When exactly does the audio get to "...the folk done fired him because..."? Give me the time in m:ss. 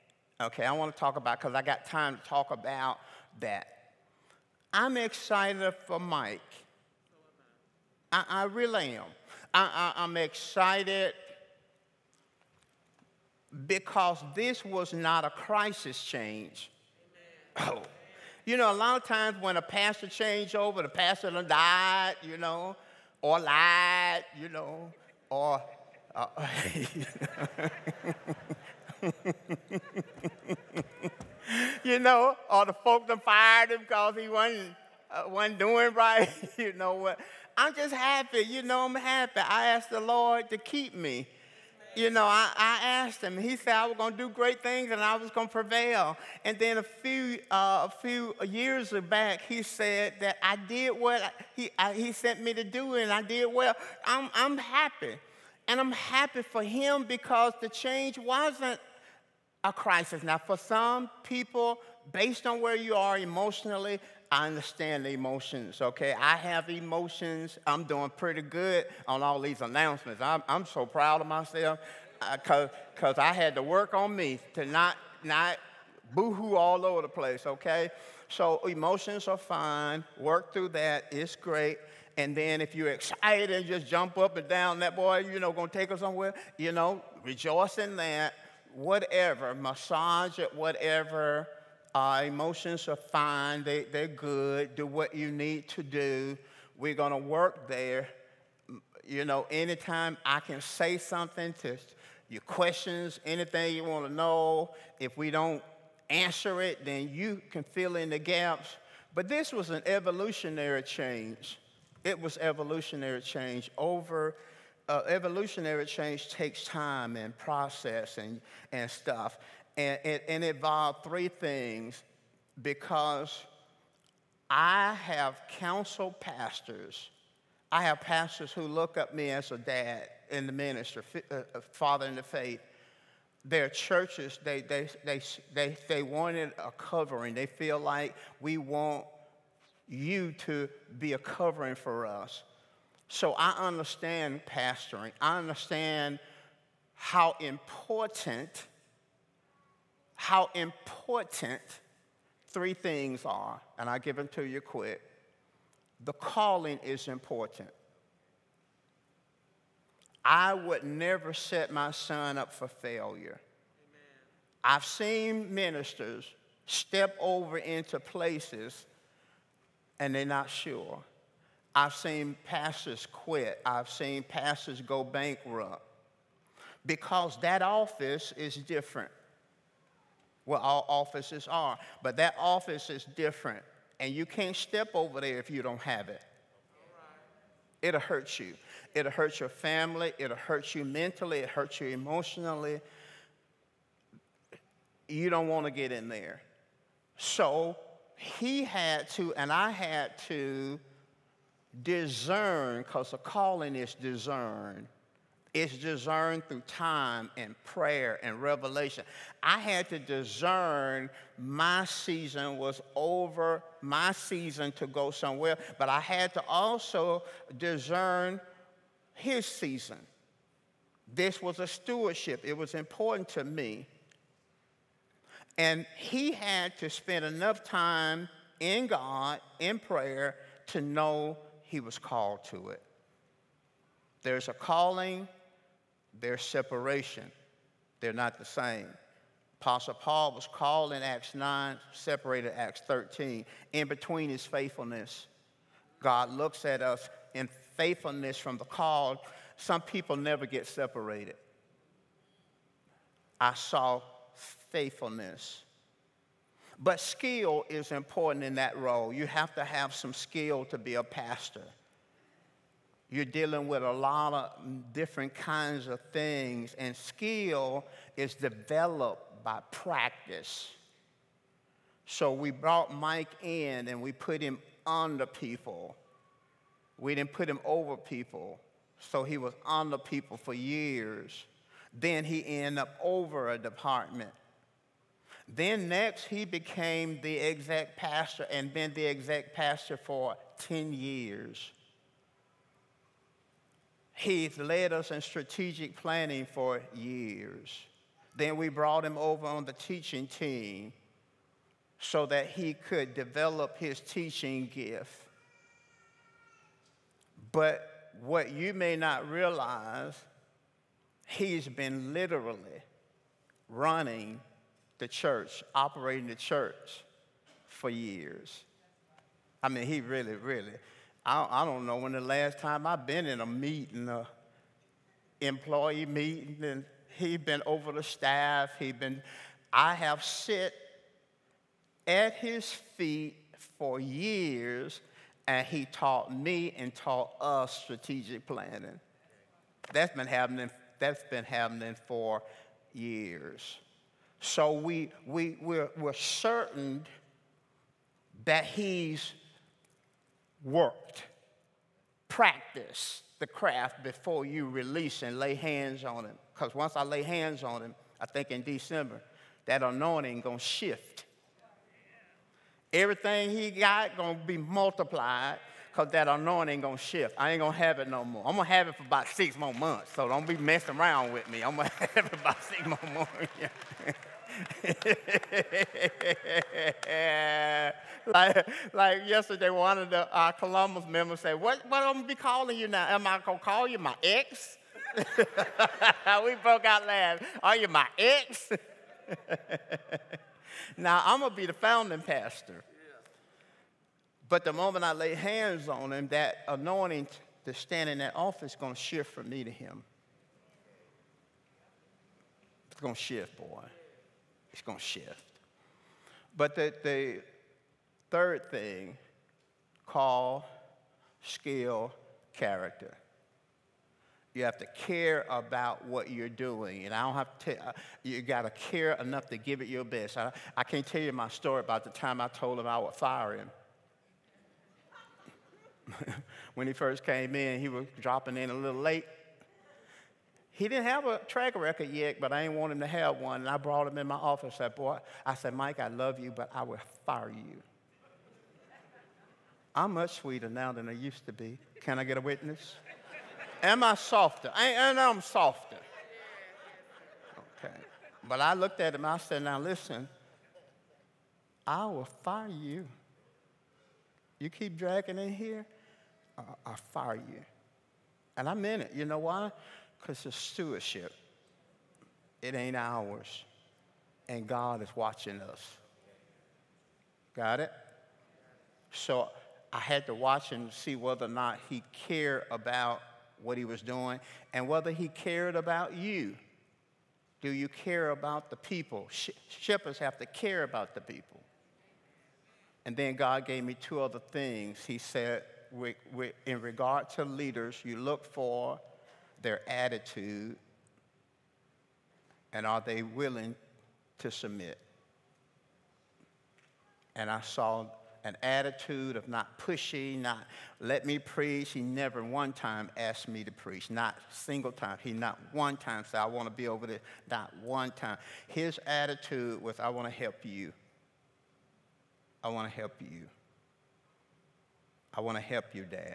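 0:32.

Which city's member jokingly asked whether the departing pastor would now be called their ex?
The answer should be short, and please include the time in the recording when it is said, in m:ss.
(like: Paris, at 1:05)
Columbus, at 6:20.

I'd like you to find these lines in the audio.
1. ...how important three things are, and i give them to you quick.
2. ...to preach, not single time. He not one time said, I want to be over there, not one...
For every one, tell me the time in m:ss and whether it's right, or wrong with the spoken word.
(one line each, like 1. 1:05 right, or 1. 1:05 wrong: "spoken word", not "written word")
1. 2:30 right
2. 8:23 right.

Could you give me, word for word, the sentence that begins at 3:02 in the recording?
But that office is different, and you can't step over there if you don't have it.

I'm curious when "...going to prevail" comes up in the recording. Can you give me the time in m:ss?
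0:45.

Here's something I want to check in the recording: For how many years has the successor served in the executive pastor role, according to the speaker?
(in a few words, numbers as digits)
10.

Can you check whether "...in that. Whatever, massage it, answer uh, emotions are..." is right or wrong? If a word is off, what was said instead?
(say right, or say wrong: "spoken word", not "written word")
wrong: "whatever", not "answer".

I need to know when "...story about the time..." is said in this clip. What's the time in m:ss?
7:01.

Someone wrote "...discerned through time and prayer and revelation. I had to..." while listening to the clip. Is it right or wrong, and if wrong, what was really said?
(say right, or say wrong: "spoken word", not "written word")
right.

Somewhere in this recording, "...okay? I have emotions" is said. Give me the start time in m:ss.
1:05.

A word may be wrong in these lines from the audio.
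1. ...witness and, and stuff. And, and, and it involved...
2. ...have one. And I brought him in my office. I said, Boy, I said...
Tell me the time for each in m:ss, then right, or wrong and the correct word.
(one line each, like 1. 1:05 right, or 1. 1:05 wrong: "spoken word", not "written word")
1. 1:57 wrong: "process", not "witness"
2. 7:13 right.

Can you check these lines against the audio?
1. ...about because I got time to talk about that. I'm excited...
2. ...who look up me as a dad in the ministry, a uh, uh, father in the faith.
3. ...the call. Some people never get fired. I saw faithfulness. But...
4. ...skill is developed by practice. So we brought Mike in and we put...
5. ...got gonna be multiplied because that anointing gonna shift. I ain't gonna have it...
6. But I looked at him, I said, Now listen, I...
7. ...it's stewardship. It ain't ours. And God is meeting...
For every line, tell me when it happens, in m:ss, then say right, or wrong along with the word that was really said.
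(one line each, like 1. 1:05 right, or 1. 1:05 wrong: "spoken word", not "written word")
1. 0:01 right
2. 2:08 right
3. 4:08 wrong: "separated", not "fired"
4. 4:26 right
5. 6:03 right
6. 7:28 right
7. 7:40 wrong: "watching", not "meeting".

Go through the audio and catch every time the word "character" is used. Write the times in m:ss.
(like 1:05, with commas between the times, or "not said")
6:52.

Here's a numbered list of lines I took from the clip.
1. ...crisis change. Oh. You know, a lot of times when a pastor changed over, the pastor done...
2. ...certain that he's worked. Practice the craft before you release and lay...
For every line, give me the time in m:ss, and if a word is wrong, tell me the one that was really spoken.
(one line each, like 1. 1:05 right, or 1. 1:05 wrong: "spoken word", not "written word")
1. 0:15 right
2. 5:46 right.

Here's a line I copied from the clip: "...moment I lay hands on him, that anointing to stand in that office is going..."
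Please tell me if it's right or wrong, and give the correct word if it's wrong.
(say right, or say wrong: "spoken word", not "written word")
right.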